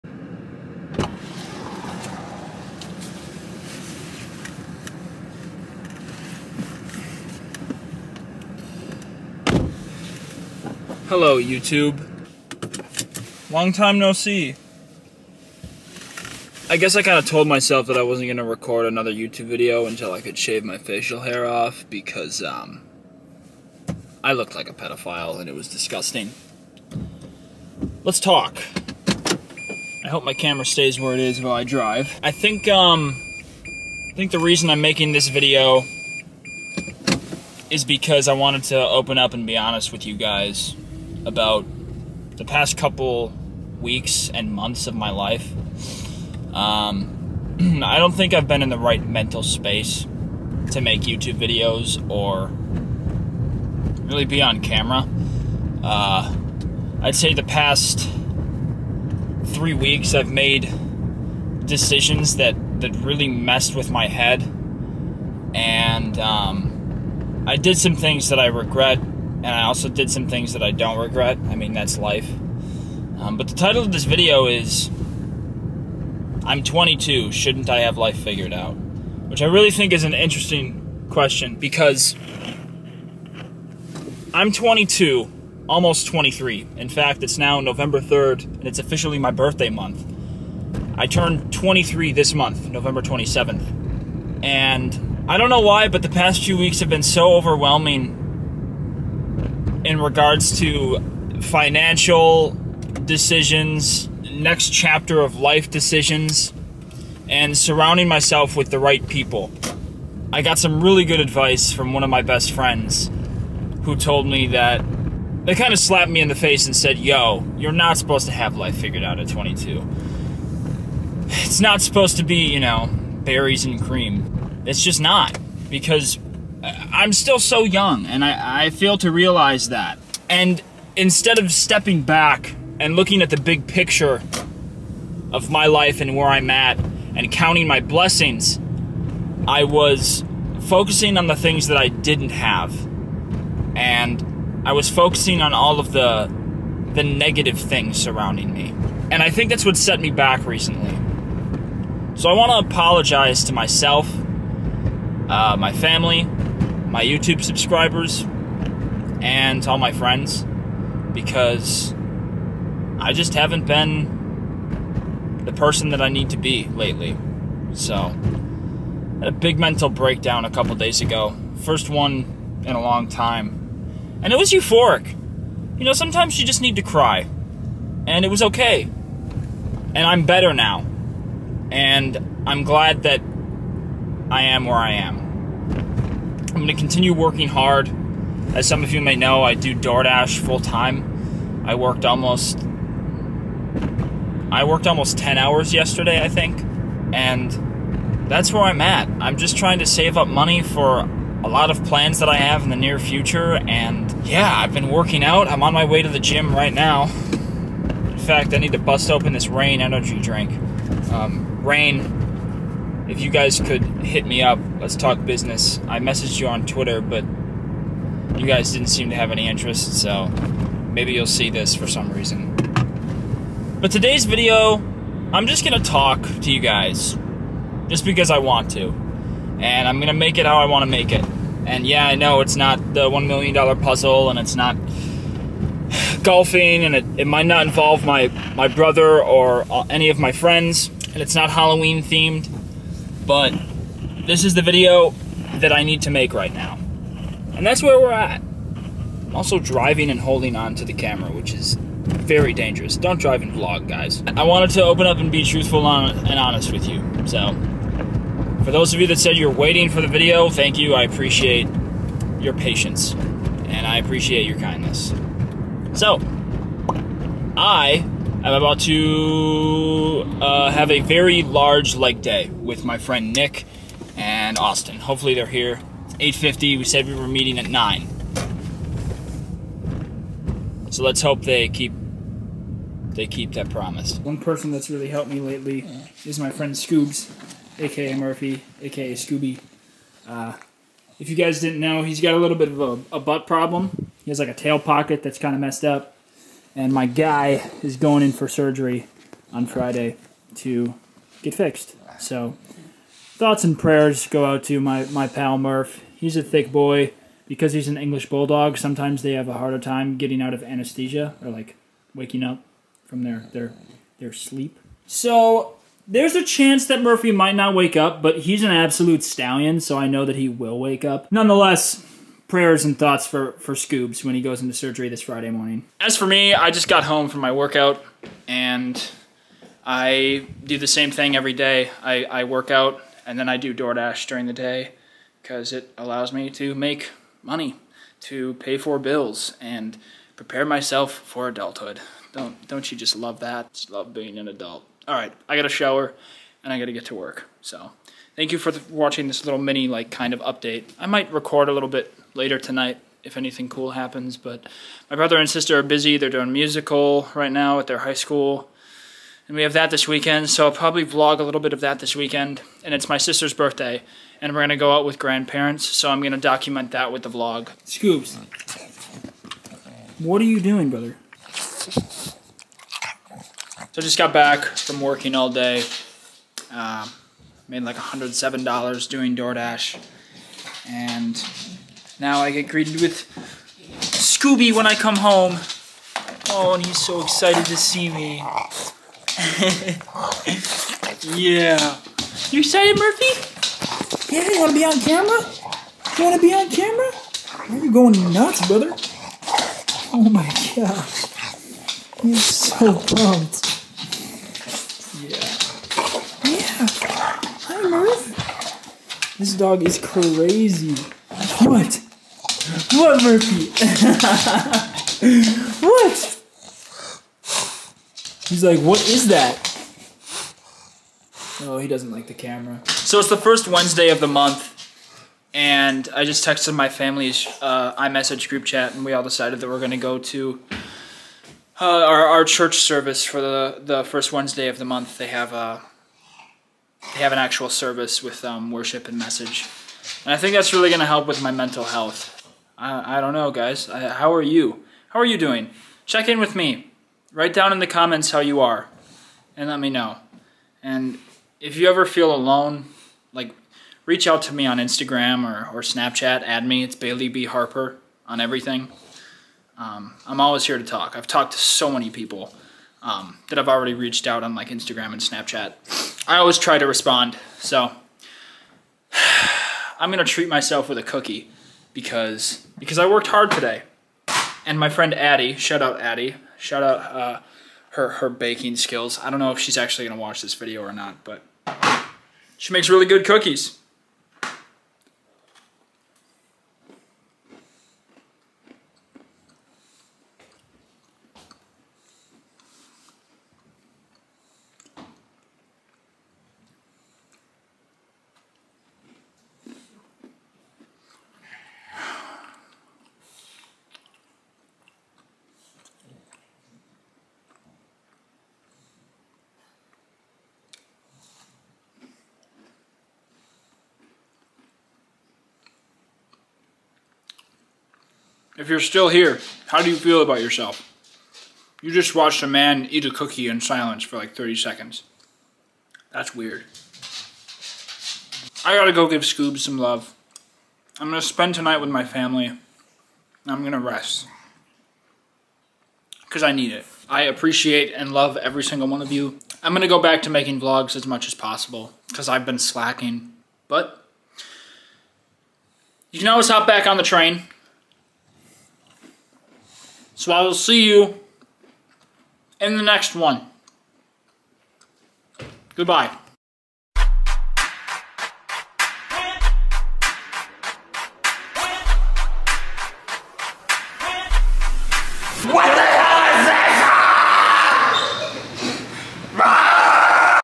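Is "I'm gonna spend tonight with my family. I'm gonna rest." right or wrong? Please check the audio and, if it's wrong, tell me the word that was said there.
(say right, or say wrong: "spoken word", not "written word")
right.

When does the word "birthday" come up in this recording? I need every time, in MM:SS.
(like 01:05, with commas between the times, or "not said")
01:29, 06:03.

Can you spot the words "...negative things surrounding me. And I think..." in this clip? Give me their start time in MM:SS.
02:27.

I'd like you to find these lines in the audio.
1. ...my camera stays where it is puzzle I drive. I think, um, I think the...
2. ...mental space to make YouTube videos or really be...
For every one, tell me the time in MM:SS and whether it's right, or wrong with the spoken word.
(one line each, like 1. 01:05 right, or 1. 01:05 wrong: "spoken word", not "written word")
1. 00:30 wrong: "while", not "puzzle"
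2. 00:49 right.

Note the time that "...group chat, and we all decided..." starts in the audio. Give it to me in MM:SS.
07:08.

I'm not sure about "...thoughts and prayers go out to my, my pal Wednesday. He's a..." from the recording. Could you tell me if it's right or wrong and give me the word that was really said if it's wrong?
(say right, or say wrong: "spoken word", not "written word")
wrong: "Murph", not "Wednesday".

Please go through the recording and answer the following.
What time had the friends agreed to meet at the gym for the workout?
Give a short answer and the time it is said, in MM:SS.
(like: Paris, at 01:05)
9, at 04:37.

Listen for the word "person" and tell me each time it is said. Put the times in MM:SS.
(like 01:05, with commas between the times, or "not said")
02:45, 04:44.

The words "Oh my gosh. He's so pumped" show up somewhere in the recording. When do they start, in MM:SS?
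06:40.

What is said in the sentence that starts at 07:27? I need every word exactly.
Write down in the comments how you are, and let me know.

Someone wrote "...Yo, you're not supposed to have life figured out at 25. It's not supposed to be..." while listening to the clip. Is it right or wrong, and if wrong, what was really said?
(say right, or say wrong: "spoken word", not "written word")
wrong: "22", not "25".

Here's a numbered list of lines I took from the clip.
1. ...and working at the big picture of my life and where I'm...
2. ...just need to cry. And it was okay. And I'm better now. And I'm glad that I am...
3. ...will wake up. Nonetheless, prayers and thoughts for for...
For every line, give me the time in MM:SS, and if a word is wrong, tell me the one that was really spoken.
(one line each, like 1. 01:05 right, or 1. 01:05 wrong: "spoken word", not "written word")
1. 02:12 wrong: "looking", not "working"
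2. 02:56 right
3. 05:20 right.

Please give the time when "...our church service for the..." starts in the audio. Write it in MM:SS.
07:12.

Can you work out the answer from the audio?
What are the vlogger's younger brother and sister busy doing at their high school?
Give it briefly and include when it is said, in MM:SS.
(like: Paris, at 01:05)
musical, at 05:56.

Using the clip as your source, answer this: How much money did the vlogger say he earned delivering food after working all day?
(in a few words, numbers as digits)
$107.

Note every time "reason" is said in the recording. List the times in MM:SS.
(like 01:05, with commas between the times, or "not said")
00:34, 03:42.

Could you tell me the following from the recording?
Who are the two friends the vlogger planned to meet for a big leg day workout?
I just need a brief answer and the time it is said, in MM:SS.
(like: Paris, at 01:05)
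Nick and Austin, at 04:33.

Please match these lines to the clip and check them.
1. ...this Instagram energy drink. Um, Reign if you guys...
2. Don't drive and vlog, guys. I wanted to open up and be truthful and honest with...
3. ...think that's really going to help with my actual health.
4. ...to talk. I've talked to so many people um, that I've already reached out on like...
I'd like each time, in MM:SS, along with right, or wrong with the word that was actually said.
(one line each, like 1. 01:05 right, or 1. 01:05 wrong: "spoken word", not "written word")
1. 03:29 wrong: "Reign", not "Instagram"
2. 04:12 right
3. 07:20 wrong: "mental", not "actual"
4. 07:40 right.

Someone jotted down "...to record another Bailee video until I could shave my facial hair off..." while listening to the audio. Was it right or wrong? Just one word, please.
wrong.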